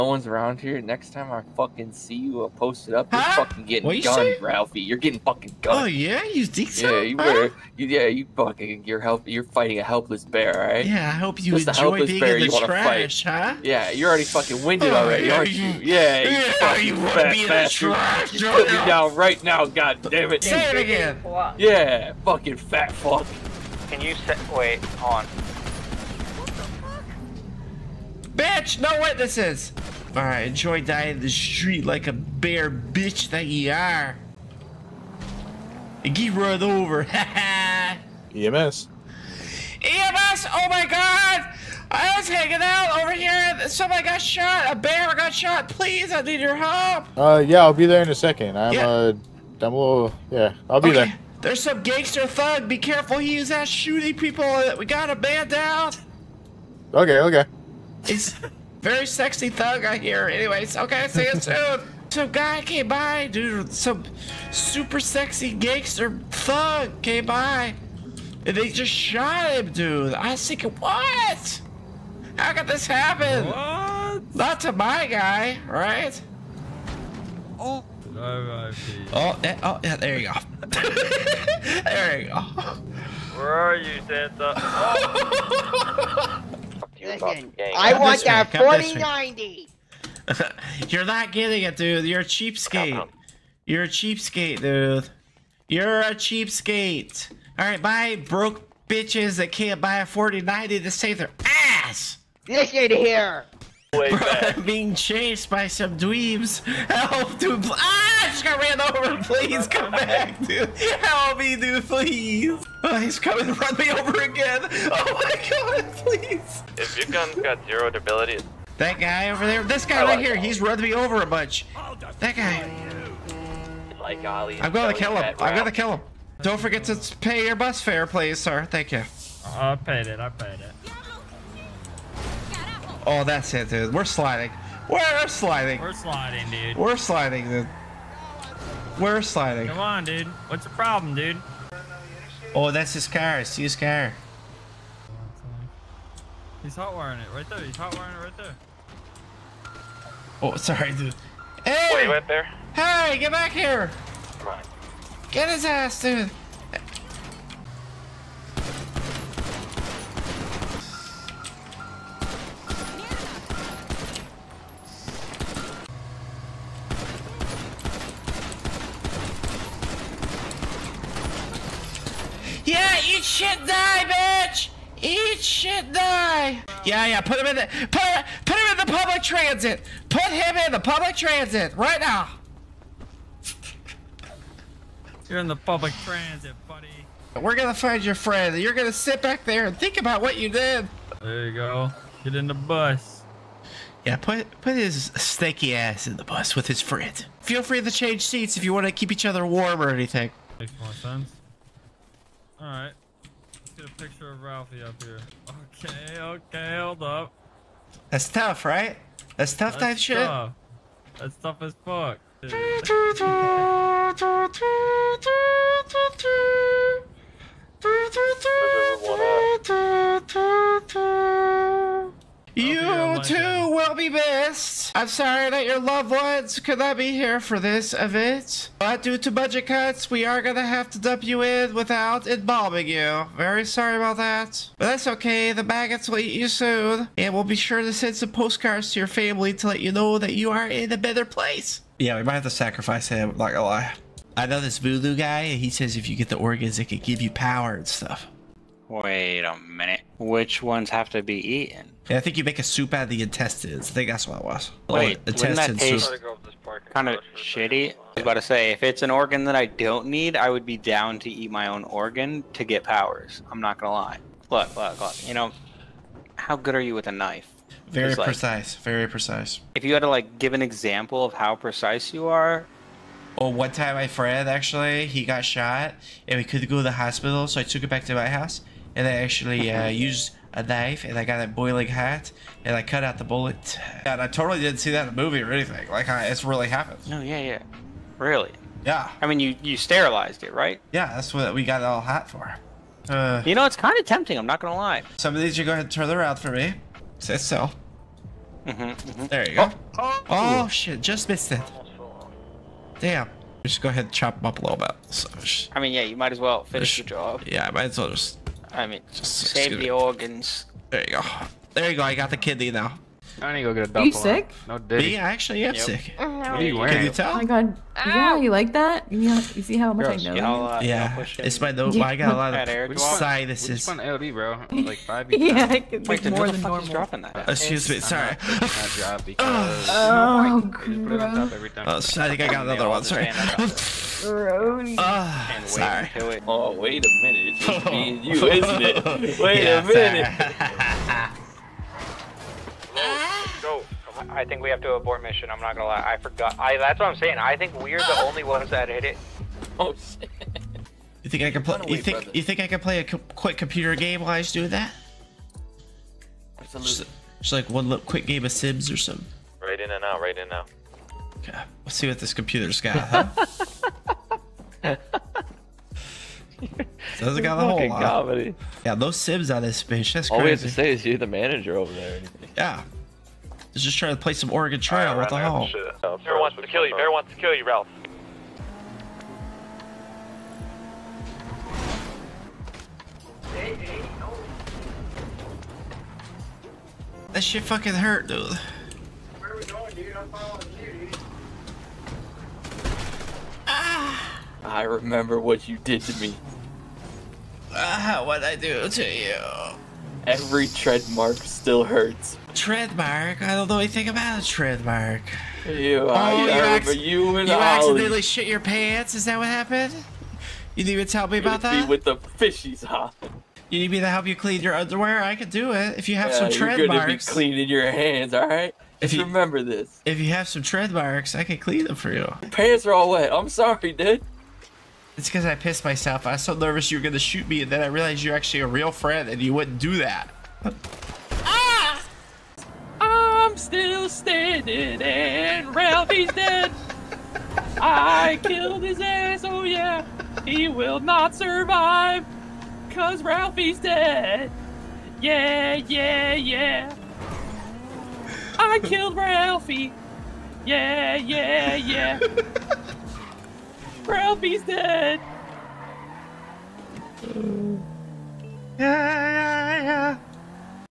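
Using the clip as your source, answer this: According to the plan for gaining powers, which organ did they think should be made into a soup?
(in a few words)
intestines.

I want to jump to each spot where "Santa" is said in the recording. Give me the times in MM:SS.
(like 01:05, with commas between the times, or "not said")
01:24.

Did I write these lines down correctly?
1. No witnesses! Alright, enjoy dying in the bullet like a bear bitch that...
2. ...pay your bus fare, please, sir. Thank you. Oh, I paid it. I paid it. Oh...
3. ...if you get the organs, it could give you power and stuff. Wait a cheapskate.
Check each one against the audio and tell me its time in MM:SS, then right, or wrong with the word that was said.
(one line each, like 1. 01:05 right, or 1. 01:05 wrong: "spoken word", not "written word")
1. 00:28 wrong: "street", not "bullet"
2. 02:07 right
3. 04:05 wrong: "minute", not "cheapskate".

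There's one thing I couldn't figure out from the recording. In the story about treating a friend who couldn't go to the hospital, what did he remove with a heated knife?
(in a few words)
the bullet.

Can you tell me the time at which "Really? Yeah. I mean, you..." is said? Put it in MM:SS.
04:48.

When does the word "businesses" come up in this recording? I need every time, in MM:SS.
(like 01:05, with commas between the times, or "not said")
not said.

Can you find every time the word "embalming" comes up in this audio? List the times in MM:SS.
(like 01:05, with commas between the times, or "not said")
03:52.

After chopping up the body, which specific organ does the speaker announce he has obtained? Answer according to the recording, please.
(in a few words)
kidney.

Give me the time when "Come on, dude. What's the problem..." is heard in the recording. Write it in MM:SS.
02:19.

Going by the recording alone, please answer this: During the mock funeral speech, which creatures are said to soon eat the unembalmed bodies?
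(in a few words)
maggots.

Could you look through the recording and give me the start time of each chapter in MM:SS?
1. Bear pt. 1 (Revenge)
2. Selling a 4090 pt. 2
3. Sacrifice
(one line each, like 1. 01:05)
1. 05:36
2. 01:26
3. 04:02.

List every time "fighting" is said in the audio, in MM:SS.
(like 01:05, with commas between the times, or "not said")
00:09.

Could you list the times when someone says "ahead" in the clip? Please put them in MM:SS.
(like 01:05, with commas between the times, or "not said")
04:55, 05:03.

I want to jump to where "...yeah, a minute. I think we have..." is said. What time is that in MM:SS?
05:39.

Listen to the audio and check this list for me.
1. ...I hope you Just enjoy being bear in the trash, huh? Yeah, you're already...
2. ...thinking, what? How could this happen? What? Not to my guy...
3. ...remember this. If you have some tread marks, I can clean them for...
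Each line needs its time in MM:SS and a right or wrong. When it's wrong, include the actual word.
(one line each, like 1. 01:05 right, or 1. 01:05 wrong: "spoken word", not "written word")
1. 00:11 right
2. 01:10 right
3. 06:59 right.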